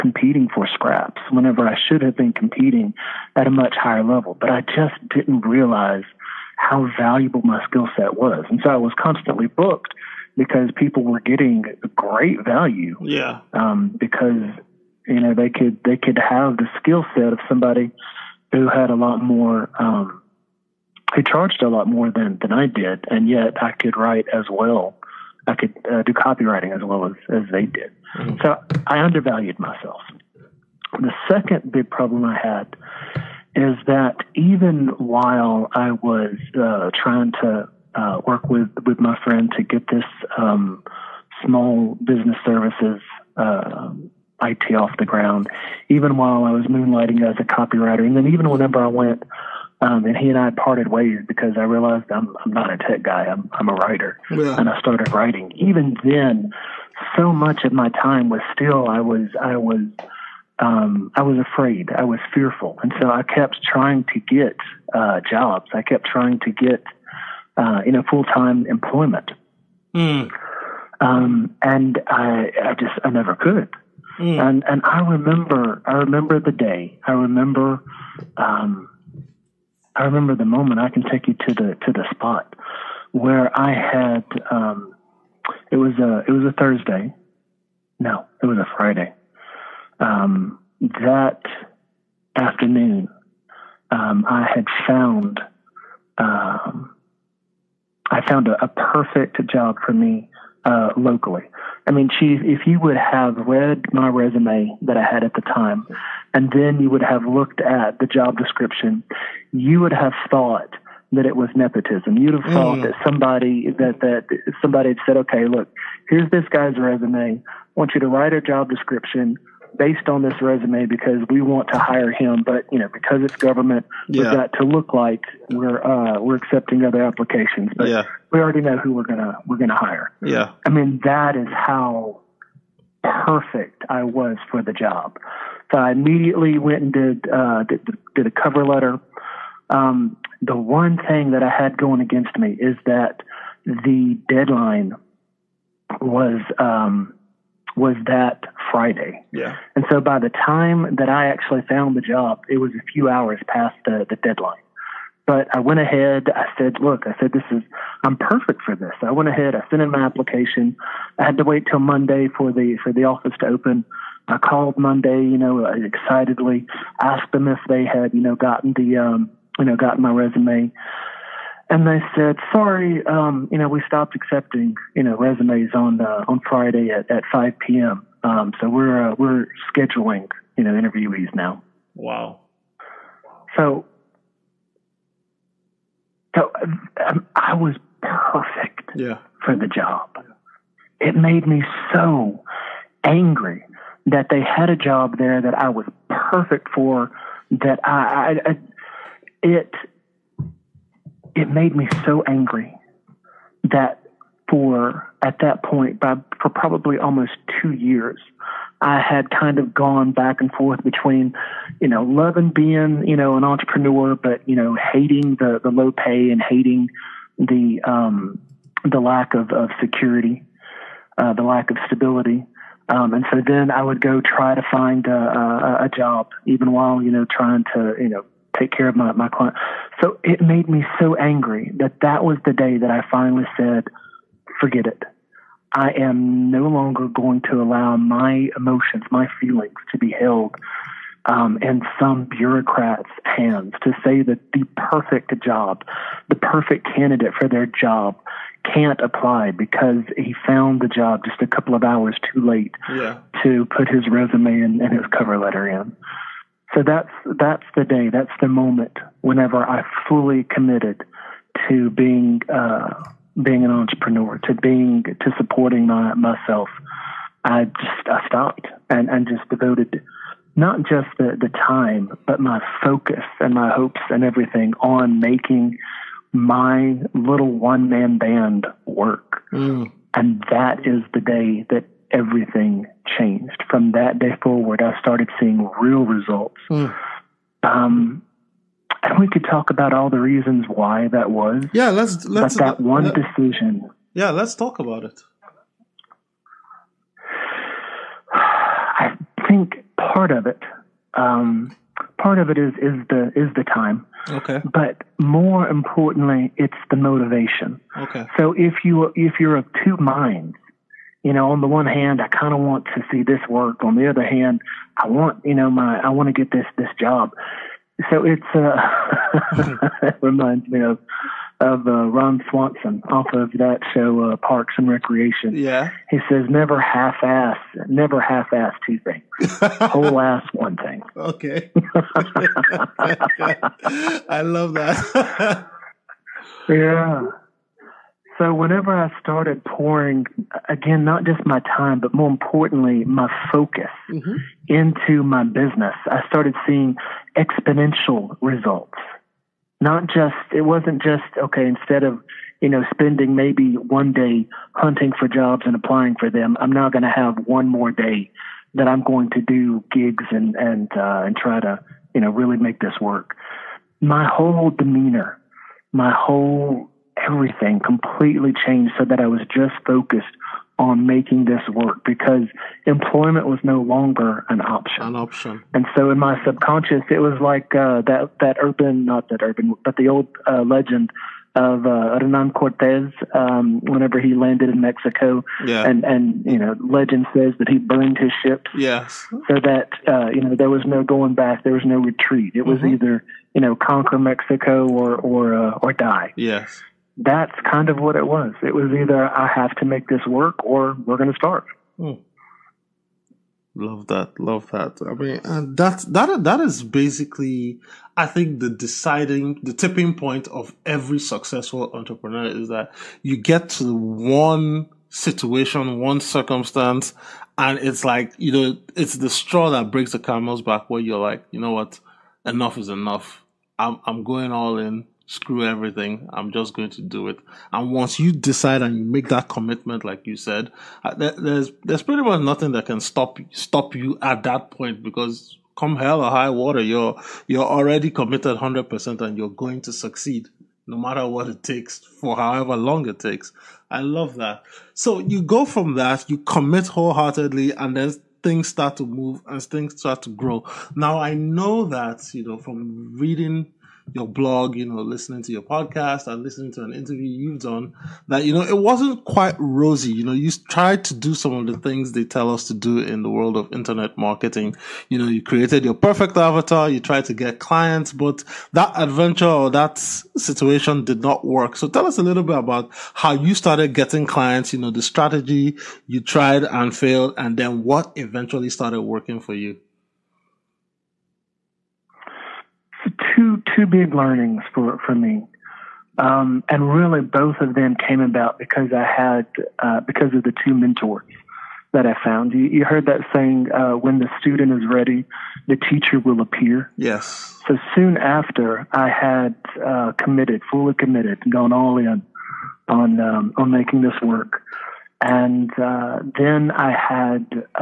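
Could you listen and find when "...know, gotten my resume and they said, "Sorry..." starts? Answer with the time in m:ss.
2:49.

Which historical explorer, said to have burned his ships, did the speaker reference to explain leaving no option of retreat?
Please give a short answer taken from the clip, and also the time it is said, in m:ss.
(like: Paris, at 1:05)
Hernan Cortez, at 6:22.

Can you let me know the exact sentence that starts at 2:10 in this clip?
Yeah, I mean that is how perfect I was for the job.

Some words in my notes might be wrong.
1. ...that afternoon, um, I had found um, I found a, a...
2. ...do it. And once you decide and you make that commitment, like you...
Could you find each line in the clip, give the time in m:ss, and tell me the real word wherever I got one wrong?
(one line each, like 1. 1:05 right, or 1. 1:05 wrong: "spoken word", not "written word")
1. 1:30 right
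2. 7:07 right.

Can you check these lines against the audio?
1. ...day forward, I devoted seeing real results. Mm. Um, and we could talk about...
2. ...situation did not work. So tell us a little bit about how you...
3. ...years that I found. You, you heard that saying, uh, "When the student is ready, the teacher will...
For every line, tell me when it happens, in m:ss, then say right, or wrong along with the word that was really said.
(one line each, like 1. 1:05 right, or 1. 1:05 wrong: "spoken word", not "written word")
1. 4:44 wrong: "started", not "devoted"
2. 7:49 right
3. 8:10 wrong: "mentors", not "years".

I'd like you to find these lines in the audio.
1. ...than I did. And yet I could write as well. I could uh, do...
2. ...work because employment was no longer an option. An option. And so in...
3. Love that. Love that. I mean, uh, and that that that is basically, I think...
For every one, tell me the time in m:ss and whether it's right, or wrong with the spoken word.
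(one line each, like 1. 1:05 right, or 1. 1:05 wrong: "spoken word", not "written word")
1. 0:22 right
2. 6:11 right
3. 6:43 right.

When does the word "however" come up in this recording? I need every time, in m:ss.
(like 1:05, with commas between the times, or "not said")
7:22.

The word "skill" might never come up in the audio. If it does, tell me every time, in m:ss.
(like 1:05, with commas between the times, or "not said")
0:07, 0:16.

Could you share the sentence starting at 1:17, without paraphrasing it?
I remember um, I remember the moment.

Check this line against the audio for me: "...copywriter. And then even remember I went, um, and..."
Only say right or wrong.
wrong.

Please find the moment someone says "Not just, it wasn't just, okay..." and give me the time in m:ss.
5:49.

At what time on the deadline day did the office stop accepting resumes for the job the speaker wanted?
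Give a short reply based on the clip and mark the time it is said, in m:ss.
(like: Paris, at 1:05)
5 p.m., at 2:57.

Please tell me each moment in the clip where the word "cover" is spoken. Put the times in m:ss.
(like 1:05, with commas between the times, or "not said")
2:18, 4:15.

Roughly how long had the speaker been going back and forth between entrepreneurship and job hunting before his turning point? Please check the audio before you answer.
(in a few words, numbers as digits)
almost two years.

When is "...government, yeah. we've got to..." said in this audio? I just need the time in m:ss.
2:03.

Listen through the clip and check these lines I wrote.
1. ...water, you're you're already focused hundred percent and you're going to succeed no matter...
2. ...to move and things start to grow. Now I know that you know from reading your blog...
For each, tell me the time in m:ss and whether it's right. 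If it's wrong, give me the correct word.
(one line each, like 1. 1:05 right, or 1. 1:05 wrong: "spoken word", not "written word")
1. 7:16 wrong: "committed", not "focused"
2. 7:28 right.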